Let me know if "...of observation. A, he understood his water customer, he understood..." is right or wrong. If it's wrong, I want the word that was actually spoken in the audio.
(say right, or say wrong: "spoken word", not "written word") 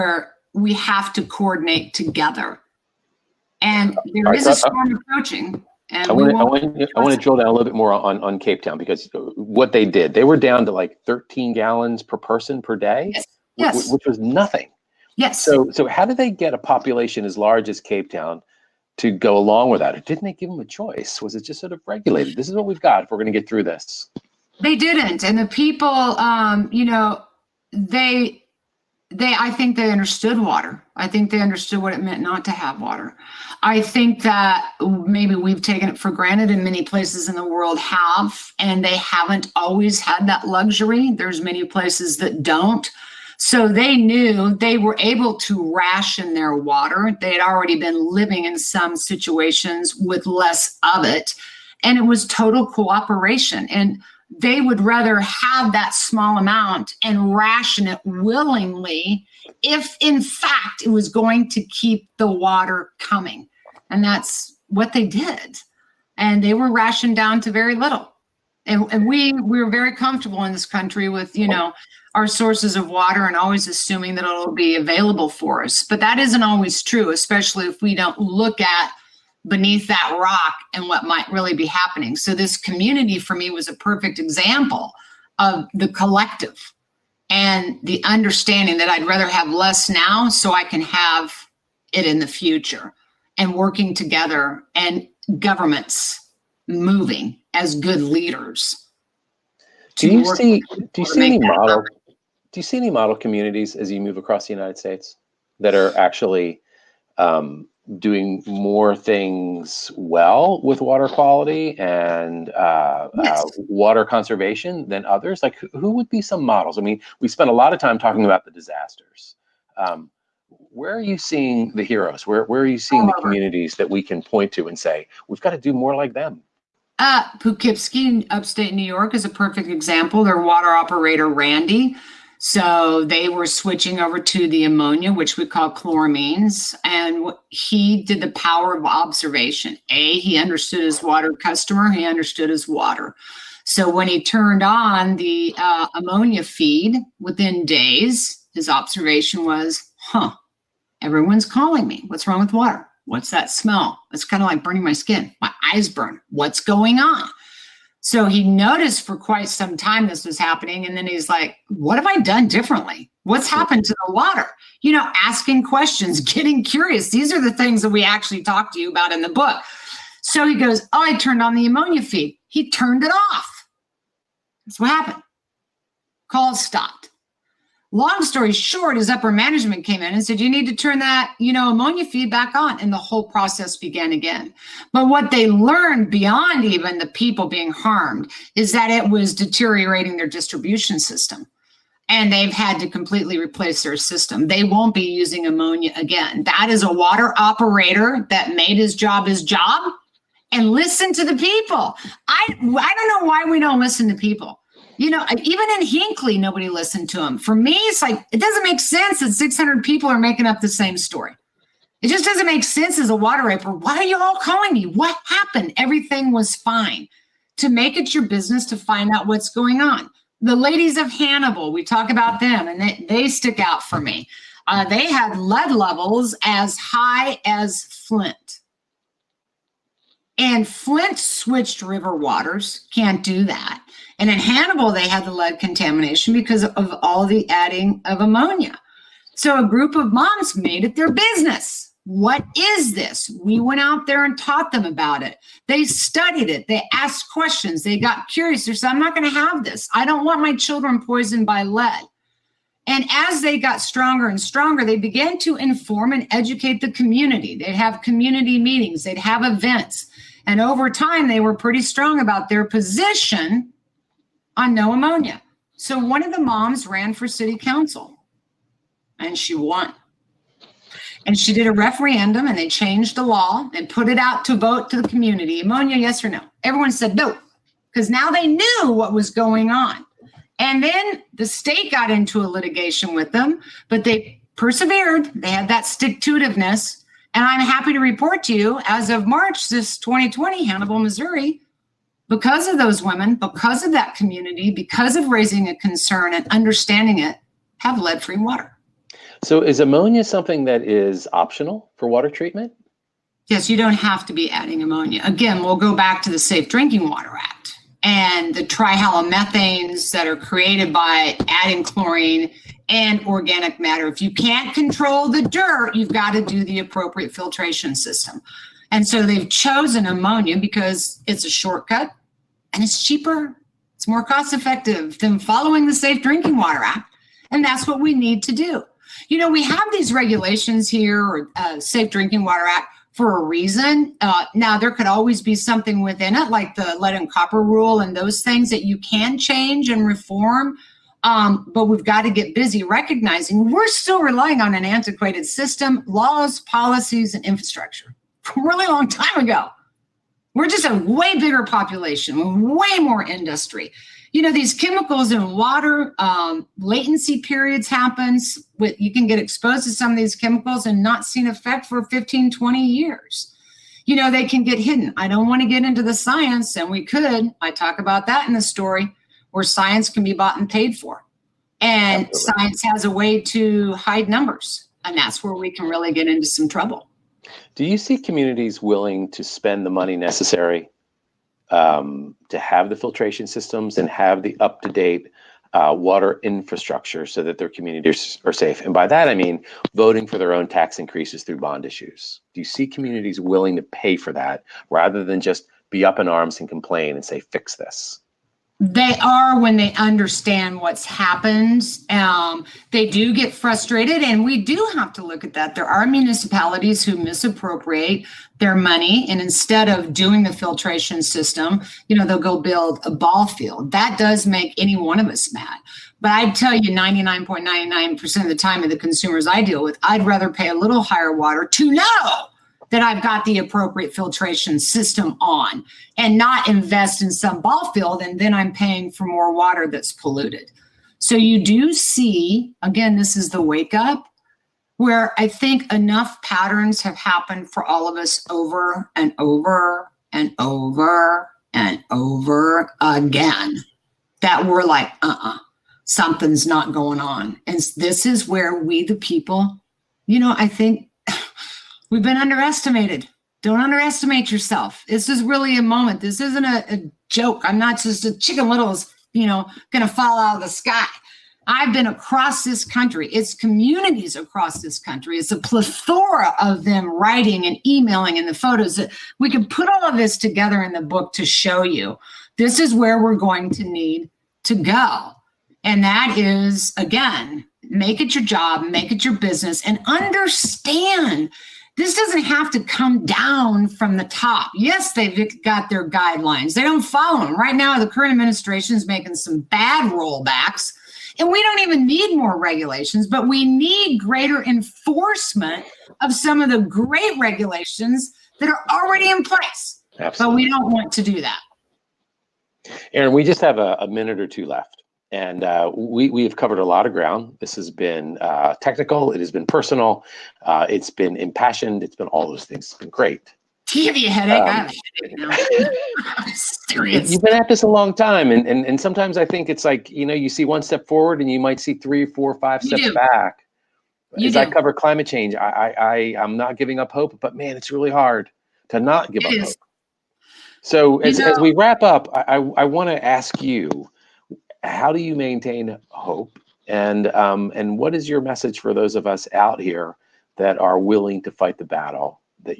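right.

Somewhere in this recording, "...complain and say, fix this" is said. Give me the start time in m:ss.
6:36.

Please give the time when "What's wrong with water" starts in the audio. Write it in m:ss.
2:32.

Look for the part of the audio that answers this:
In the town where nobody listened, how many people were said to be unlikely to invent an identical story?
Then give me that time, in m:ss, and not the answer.
3:29.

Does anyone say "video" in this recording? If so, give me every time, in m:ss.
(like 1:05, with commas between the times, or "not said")
not said.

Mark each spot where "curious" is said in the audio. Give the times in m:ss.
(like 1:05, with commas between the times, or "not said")
2:46, 4:08.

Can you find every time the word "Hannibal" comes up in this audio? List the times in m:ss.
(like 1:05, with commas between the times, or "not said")
3:41, 3:54, 4:50.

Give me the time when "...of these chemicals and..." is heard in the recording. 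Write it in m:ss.
6:00.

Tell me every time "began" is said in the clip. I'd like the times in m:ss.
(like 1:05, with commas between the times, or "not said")
3:03, 4:14.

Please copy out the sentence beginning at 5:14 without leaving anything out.
If you can't control the dirt, you've got to do the appropriate filtration system.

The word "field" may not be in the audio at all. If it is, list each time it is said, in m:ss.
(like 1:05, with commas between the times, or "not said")
6:53, 7:07.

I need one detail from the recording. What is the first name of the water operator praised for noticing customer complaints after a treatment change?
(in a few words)
Randy.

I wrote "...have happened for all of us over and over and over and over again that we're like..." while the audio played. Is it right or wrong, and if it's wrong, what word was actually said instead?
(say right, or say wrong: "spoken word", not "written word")
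right.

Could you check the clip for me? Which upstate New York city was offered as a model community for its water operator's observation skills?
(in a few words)
Poughkeepsie.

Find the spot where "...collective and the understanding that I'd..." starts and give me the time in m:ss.
1:25.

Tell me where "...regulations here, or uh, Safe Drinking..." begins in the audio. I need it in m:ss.
5:30.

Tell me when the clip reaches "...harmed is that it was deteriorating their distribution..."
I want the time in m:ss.
3:07.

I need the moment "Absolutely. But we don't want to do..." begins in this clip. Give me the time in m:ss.
8:20.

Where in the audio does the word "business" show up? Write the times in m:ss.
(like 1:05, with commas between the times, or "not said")
3:38, 4:01, 7:59.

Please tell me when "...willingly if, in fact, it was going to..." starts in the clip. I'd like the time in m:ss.
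0:58.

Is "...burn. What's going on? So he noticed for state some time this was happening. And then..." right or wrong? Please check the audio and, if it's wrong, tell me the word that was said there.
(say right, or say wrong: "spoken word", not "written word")
wrong: "quite", not "state".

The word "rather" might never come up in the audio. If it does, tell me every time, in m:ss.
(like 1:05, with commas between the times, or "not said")
0:54, 1:29, 6:34, 7:00.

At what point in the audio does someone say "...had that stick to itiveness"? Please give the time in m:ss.
4:45.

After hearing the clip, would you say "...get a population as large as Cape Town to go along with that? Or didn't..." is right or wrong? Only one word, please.
right.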